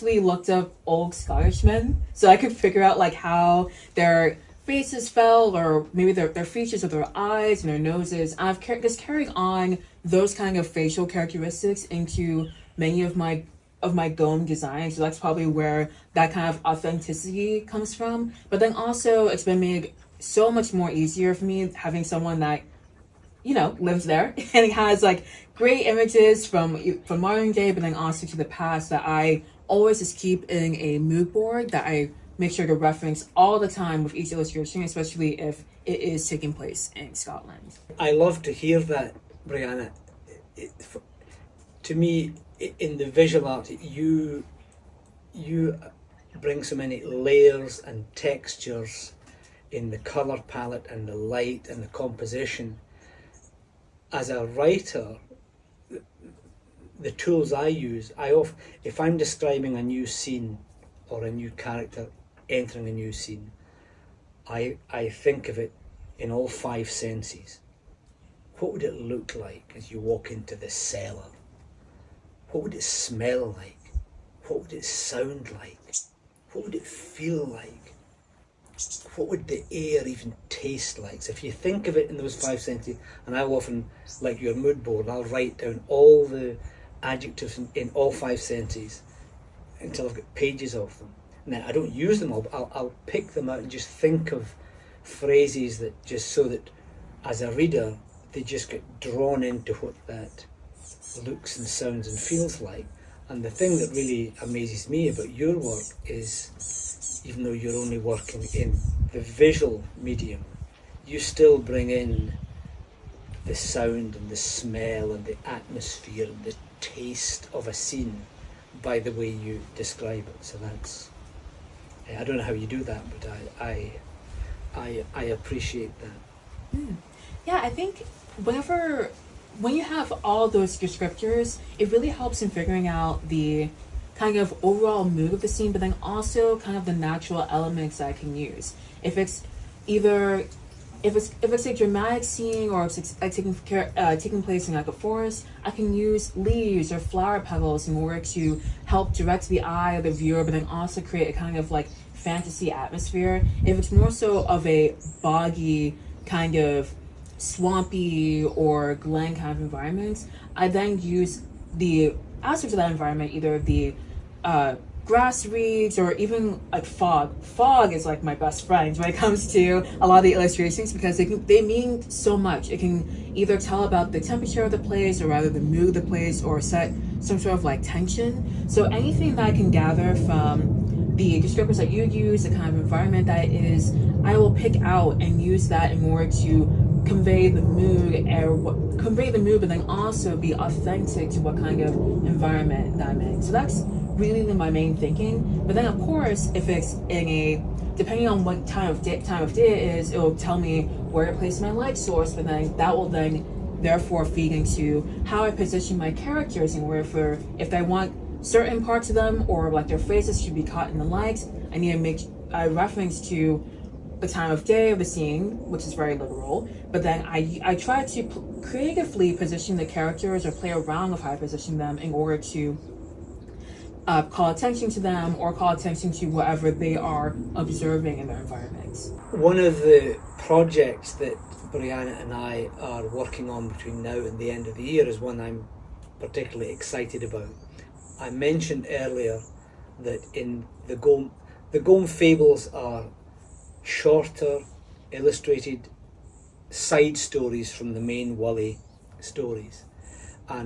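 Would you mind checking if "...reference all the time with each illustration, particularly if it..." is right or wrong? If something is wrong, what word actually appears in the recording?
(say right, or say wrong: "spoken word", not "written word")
wrong: "especially", not "particularly".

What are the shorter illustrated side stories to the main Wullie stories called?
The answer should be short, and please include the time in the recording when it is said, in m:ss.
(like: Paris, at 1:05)
Gome Fables, at 4:01.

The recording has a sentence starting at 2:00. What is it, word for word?
So that's, eh, I don't know how you do that, but I, I, I, I appreciate that.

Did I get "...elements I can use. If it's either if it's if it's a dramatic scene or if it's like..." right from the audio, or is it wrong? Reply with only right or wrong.
right.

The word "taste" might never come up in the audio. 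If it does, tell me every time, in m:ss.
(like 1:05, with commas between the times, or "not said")
1:20, 1:56.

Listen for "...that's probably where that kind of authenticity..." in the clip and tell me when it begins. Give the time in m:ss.
0:15.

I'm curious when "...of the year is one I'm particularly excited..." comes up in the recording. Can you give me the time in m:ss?
3:54.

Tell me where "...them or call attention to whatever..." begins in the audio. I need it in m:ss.
3:44.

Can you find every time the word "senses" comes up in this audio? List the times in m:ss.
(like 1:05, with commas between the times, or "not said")
1:06, 1:22, 1:28.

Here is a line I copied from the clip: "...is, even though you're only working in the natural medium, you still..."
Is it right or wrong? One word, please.
wrong.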